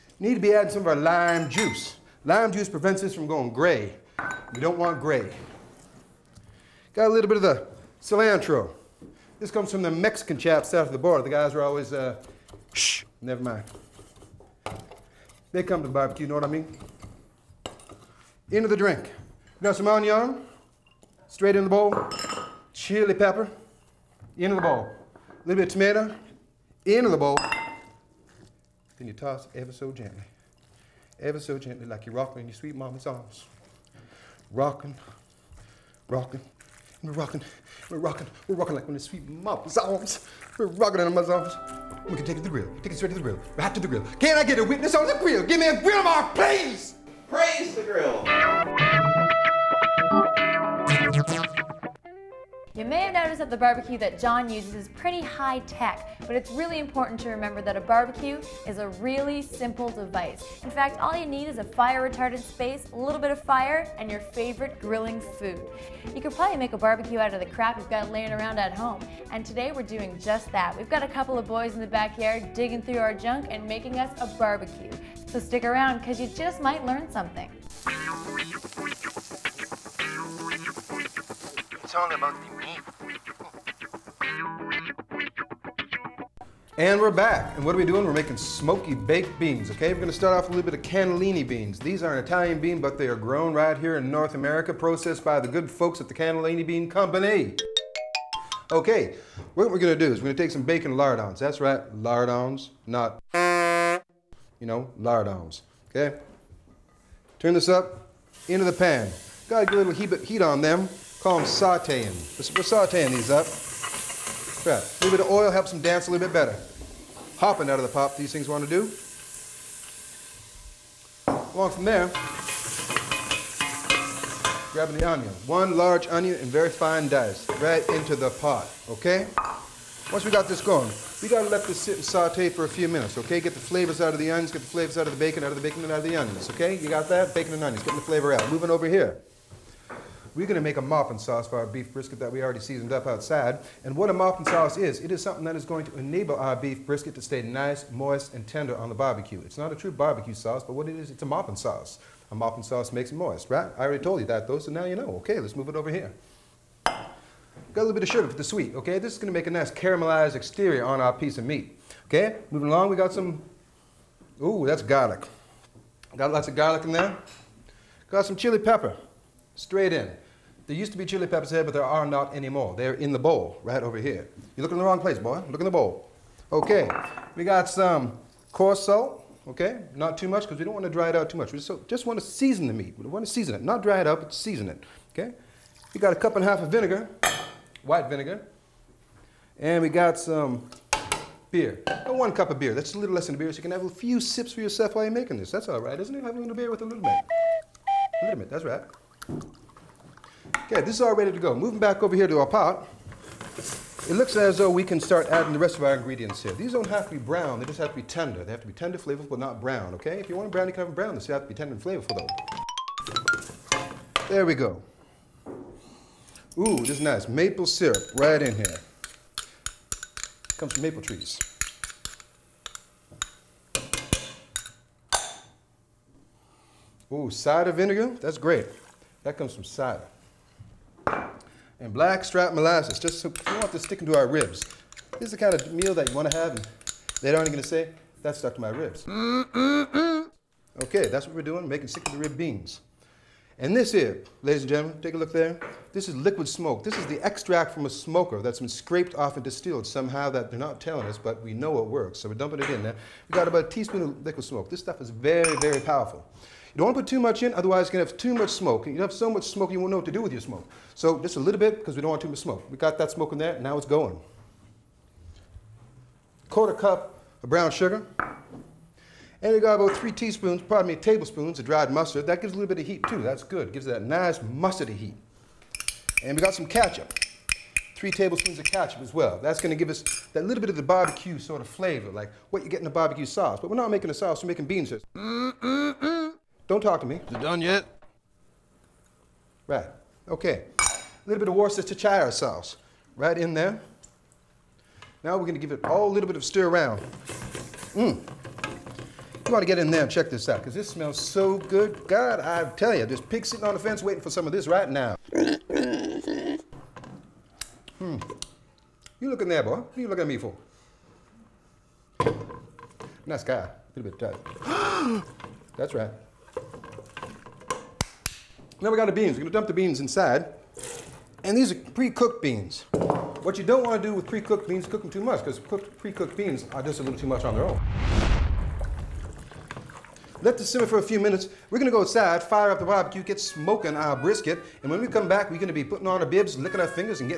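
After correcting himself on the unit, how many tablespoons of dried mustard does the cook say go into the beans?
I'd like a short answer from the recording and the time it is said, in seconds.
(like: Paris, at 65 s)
3 tablespoons, at 269 s.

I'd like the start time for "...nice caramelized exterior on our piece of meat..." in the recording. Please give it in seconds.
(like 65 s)
159 s.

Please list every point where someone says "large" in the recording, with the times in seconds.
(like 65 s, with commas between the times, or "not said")
125 s.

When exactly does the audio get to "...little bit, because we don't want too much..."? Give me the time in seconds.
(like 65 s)
261 s.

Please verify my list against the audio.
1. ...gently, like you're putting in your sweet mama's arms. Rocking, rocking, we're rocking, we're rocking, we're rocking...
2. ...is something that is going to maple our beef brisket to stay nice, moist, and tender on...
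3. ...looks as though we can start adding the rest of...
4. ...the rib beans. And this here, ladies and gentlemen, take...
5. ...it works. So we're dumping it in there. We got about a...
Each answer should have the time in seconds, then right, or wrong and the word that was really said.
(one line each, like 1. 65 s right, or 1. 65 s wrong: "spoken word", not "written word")
1. 31 s wrong: "rocking", not "putting"
2. 145 s wrong: "enable", not "maple"
3. 204 s right
4. 242 s right
5. 251 s right.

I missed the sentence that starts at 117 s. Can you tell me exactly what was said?
Hopping out of the pop, these things want to do.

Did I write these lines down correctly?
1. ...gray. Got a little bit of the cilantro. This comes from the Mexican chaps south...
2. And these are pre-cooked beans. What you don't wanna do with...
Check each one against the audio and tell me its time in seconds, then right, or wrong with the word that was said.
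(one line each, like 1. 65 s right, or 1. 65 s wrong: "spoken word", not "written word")
1. 4 s right
2. 321 s right.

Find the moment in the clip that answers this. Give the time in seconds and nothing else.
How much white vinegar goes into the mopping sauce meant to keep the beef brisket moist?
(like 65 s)
186 s.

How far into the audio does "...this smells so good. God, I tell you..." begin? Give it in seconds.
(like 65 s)
300 s.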